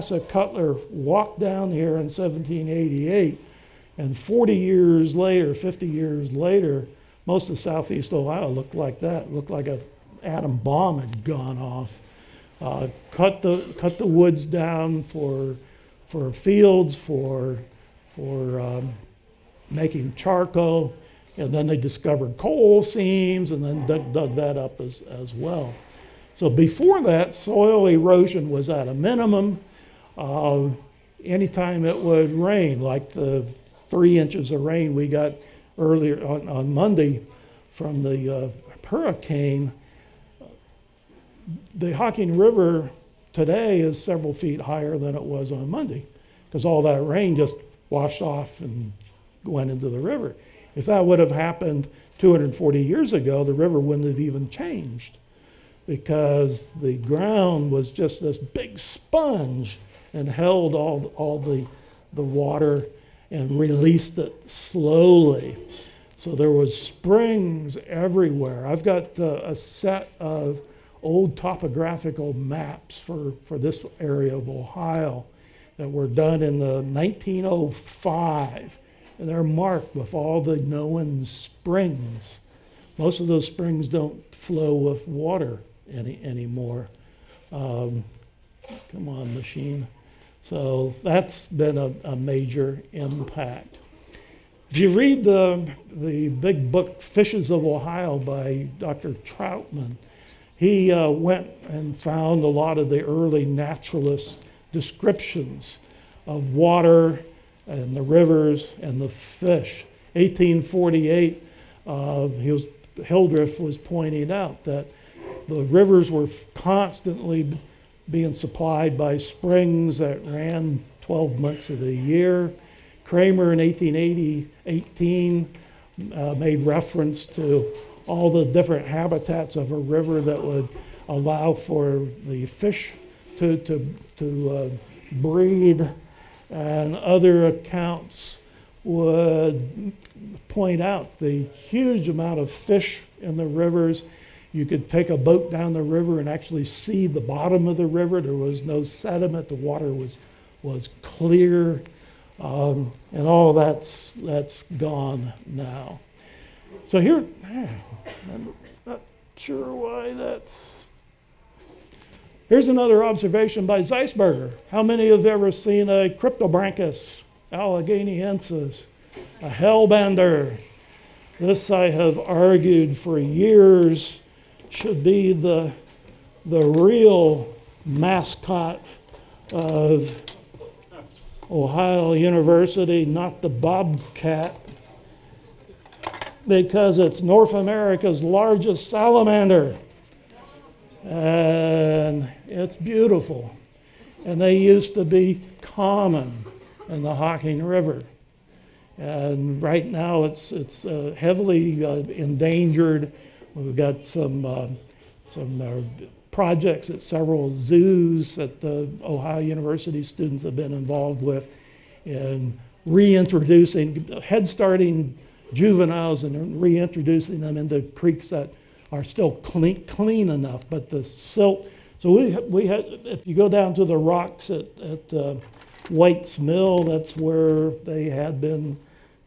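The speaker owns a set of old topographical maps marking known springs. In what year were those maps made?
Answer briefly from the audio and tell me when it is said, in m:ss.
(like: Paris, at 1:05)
1905, at 1:16.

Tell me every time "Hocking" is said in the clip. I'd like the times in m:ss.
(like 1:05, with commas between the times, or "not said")
0:41, 3:17.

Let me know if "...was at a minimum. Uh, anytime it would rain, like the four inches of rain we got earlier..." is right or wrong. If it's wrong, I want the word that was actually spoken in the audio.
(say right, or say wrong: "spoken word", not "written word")
wrong: "three", not "four".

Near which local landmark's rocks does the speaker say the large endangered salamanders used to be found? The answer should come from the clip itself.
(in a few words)
White's Mill.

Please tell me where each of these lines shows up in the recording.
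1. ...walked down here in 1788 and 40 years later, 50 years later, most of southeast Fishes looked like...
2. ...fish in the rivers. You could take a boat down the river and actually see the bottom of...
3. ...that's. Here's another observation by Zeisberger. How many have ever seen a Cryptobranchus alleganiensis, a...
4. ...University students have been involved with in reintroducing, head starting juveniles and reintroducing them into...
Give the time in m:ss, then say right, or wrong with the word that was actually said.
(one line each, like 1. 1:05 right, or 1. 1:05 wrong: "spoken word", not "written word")
1. 0:00 wrong: "Ohio", not "Fishes"
2. 2:22 right
3. 2:40 right
4. 3:29 right.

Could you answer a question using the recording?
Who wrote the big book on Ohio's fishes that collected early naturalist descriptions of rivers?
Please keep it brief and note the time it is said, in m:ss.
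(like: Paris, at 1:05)
Dr. Trautman, at 1:38.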